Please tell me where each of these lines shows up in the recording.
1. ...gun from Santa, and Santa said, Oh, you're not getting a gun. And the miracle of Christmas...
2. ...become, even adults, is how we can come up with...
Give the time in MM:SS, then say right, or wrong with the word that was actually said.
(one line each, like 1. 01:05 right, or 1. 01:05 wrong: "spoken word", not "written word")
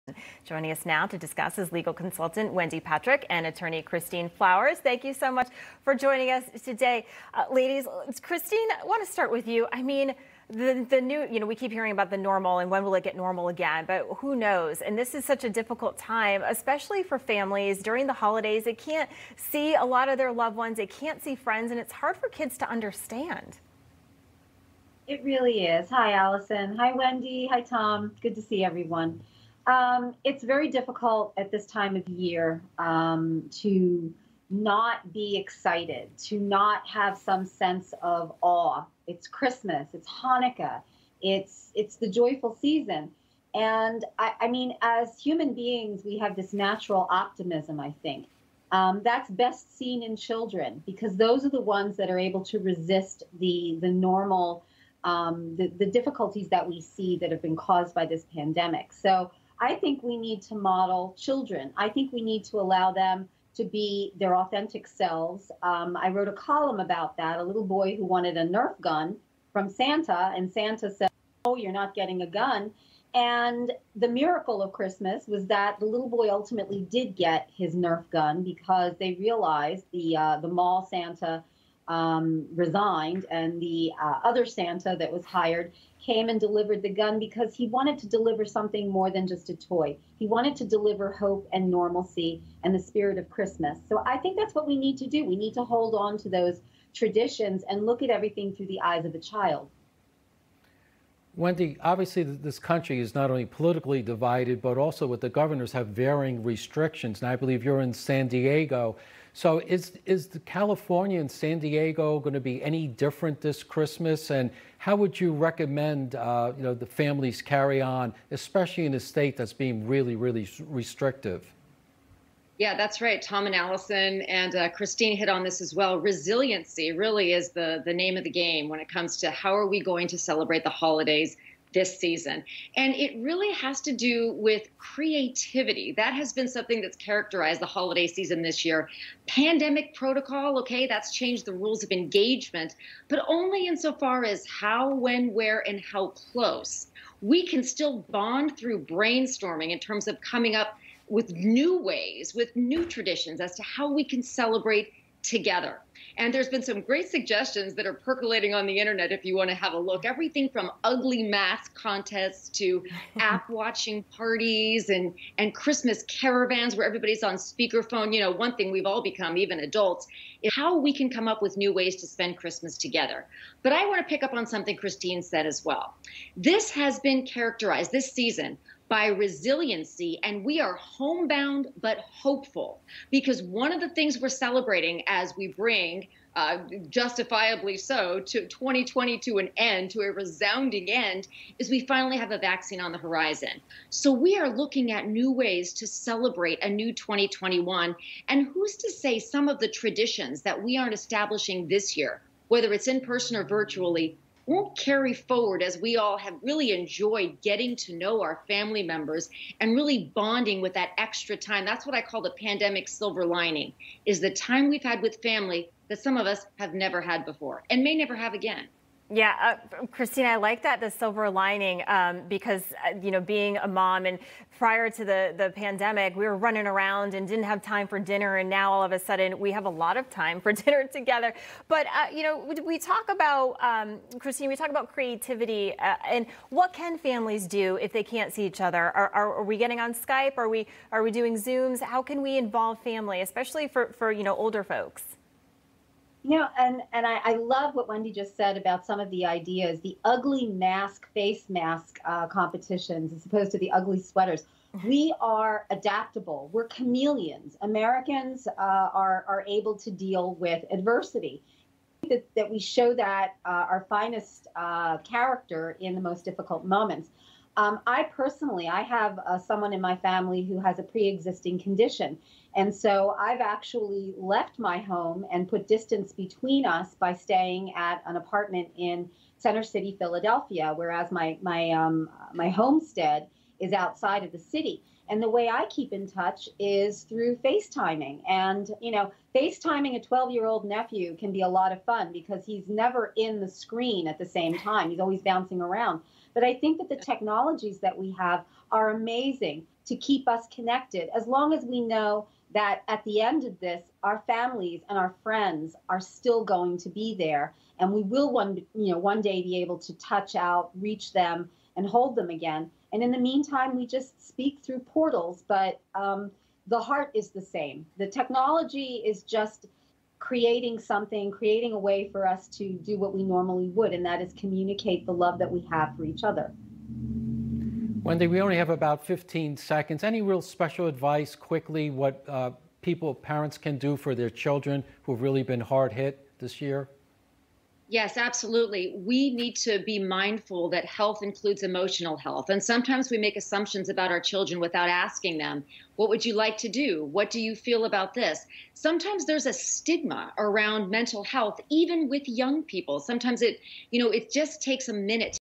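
1. 01:08 right
2. 02:49 right.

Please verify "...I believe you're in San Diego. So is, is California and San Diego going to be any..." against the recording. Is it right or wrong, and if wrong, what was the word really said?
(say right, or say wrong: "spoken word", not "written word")
right.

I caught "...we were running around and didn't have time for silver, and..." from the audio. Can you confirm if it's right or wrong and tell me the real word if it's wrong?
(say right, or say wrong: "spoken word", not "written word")
wrong: "dinner", not "silver".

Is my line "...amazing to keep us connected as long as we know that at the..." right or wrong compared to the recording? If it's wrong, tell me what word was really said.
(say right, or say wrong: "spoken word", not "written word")
right.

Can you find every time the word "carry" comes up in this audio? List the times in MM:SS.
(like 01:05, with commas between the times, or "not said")
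01:57, 03:24.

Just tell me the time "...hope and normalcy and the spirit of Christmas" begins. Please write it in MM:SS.
01:31.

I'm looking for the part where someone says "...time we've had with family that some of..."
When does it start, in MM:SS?
03:34.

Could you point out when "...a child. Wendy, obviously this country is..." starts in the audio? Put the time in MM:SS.
01:39.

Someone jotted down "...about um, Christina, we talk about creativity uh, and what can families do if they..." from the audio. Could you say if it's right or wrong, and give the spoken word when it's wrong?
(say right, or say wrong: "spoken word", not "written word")
right.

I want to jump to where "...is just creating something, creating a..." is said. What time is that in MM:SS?
05:19.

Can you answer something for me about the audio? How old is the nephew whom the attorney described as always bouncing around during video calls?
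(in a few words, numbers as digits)
12.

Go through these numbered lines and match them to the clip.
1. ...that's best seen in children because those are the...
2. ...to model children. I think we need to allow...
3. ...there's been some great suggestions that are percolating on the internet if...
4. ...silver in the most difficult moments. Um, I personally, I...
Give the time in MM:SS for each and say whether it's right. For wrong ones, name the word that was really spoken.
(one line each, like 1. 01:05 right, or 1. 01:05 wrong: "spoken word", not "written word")
1. 00:49 right
2. 01:00 right
3. 02:36 right
4. 04:24 wrong: "character", not "silver".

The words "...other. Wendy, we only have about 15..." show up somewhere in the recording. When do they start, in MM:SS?
05:26.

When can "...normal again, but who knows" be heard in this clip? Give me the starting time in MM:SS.
00:13.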